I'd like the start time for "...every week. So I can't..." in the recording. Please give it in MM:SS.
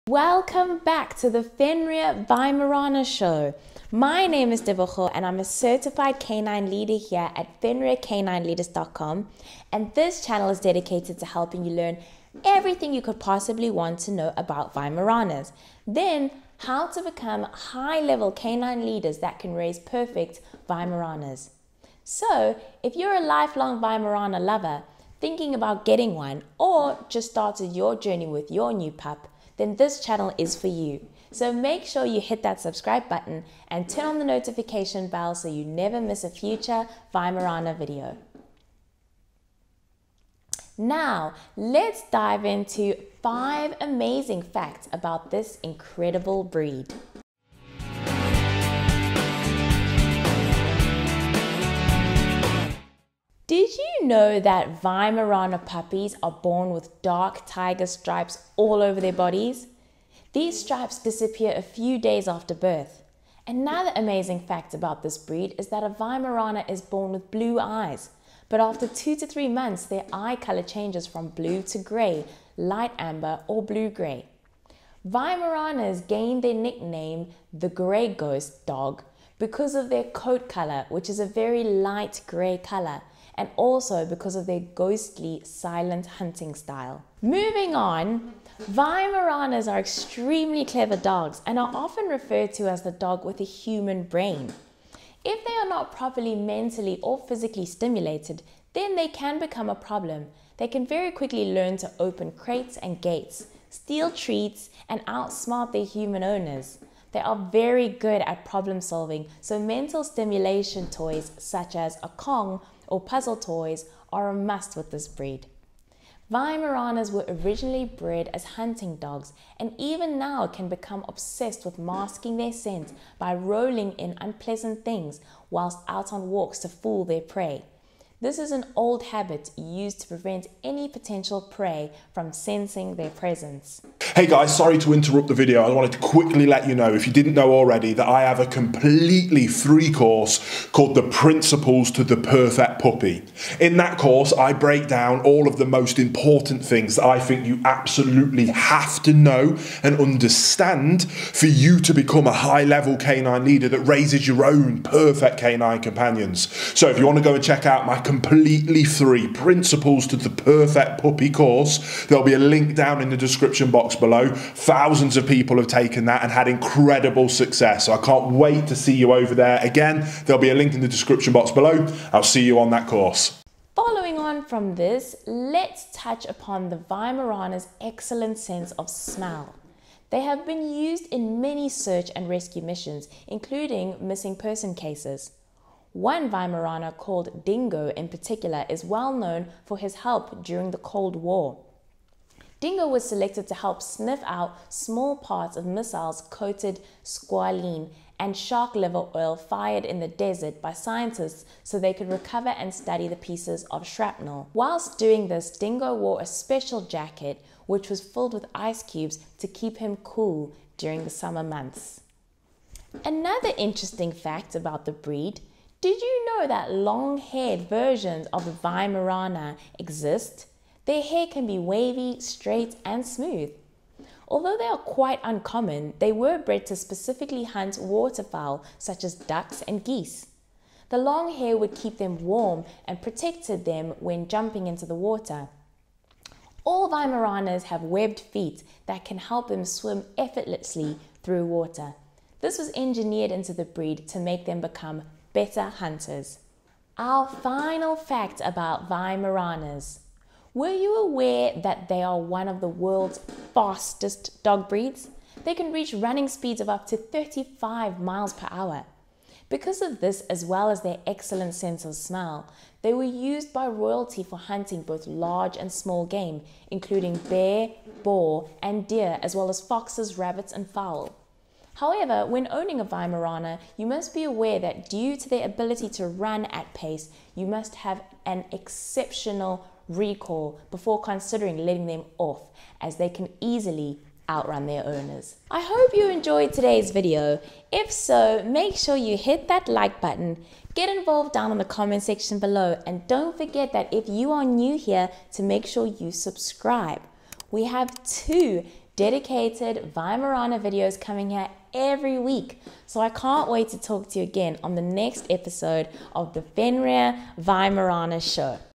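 05:01.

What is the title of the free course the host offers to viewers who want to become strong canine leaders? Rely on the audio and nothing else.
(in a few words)
The Principles to the Perfect Puppy.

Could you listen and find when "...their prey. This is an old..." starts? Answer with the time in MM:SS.
02:07.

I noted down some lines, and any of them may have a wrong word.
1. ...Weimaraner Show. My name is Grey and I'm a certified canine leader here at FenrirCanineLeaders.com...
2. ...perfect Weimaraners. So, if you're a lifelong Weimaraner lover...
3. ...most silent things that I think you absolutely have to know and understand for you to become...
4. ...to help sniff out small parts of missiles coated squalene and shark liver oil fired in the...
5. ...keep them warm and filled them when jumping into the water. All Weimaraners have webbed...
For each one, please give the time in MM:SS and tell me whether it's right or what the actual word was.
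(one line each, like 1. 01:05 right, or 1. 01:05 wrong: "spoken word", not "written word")
1. 00:02 wrong: "Devocho", not "Grey"
2. 00:19 right
3. 02:25 wrong: "important", not "silent"
4. 03:13 right
5. 03:51 wrong: "protected", not "filled".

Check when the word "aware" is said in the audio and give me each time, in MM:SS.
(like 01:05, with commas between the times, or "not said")
04:10, 04:34.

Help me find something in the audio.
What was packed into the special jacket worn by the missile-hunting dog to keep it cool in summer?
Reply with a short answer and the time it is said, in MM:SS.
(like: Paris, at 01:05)
Ice cubes, at 03:28.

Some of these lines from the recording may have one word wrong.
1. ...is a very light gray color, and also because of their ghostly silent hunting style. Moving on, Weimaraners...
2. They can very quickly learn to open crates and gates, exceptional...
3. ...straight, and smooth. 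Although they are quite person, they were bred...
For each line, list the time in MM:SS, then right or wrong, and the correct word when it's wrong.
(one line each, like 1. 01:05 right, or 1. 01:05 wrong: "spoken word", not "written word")
1. 01:21 right
2. 01:40 wrong: "steal", not "exceptional"
3. 03:42 wrong: "uncommon", not "person".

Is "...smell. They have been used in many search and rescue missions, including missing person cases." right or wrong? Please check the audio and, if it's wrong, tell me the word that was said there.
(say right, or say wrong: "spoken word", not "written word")
right.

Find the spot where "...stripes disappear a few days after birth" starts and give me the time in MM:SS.
01:00.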